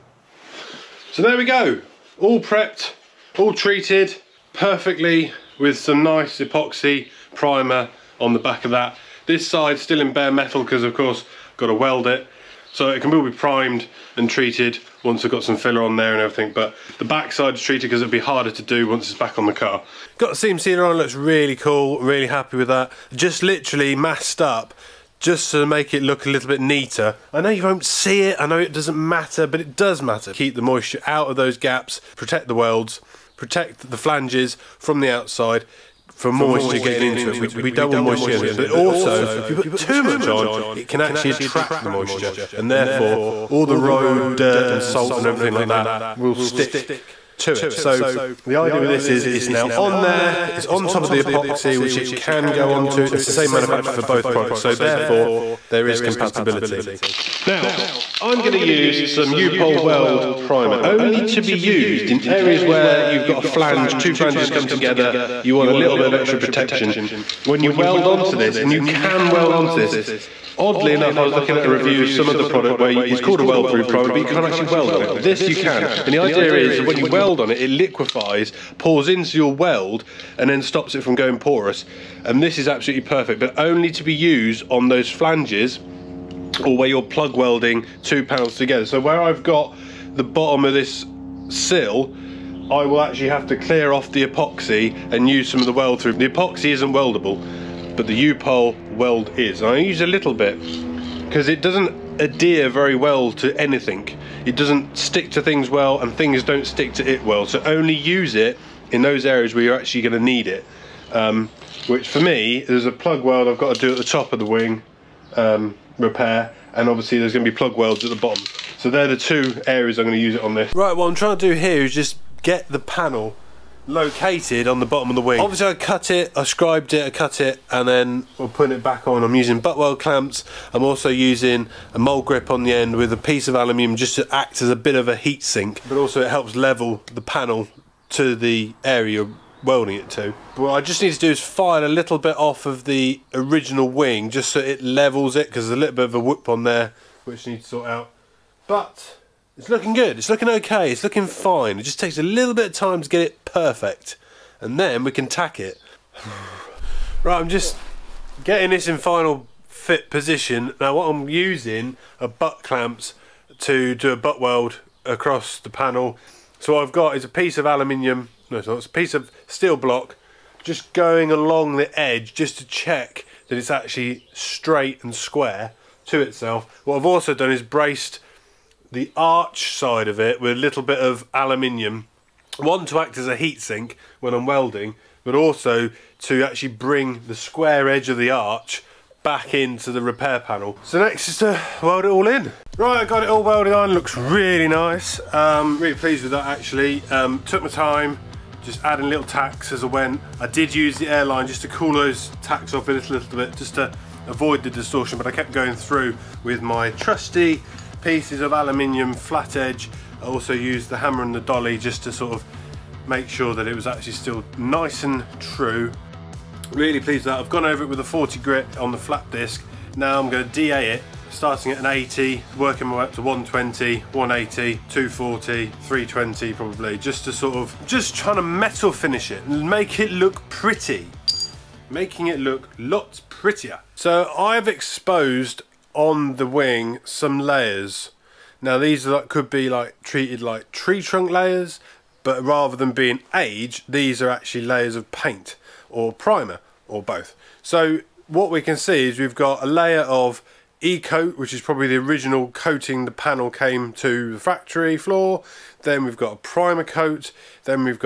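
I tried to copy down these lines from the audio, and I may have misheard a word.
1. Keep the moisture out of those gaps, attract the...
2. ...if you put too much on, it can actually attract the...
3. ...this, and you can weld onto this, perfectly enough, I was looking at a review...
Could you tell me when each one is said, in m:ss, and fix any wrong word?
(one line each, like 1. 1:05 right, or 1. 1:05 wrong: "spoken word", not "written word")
1. 0:30 wrong: "protect", not "attract"
2. 0:39 right
3. 1:08 wrong: "oddly", not "perfectly".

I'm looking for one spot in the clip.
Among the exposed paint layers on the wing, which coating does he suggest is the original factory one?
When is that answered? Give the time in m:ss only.
4:10.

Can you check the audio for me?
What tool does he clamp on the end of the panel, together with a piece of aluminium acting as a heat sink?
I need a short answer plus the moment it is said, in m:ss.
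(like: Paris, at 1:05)
mole grip, at 2:11.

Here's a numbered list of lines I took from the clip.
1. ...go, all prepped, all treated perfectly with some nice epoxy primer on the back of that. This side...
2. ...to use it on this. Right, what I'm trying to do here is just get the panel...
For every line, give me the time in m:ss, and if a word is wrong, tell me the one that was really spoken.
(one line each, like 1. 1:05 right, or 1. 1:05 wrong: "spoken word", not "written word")
1. 0:01 right
2. 2:00 right.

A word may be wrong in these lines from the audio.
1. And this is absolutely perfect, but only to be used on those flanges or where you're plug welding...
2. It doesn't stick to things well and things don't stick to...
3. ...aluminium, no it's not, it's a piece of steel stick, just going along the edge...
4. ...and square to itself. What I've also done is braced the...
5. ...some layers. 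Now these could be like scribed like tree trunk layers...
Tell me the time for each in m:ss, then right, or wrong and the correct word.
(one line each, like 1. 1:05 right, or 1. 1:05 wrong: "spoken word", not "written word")
1. 1:22 right
2. 1:44 right
3. 2:47 wrong: "block", not "stick"
4. 2:55 right
5. 3:57 wrong: "treated", not "scribed".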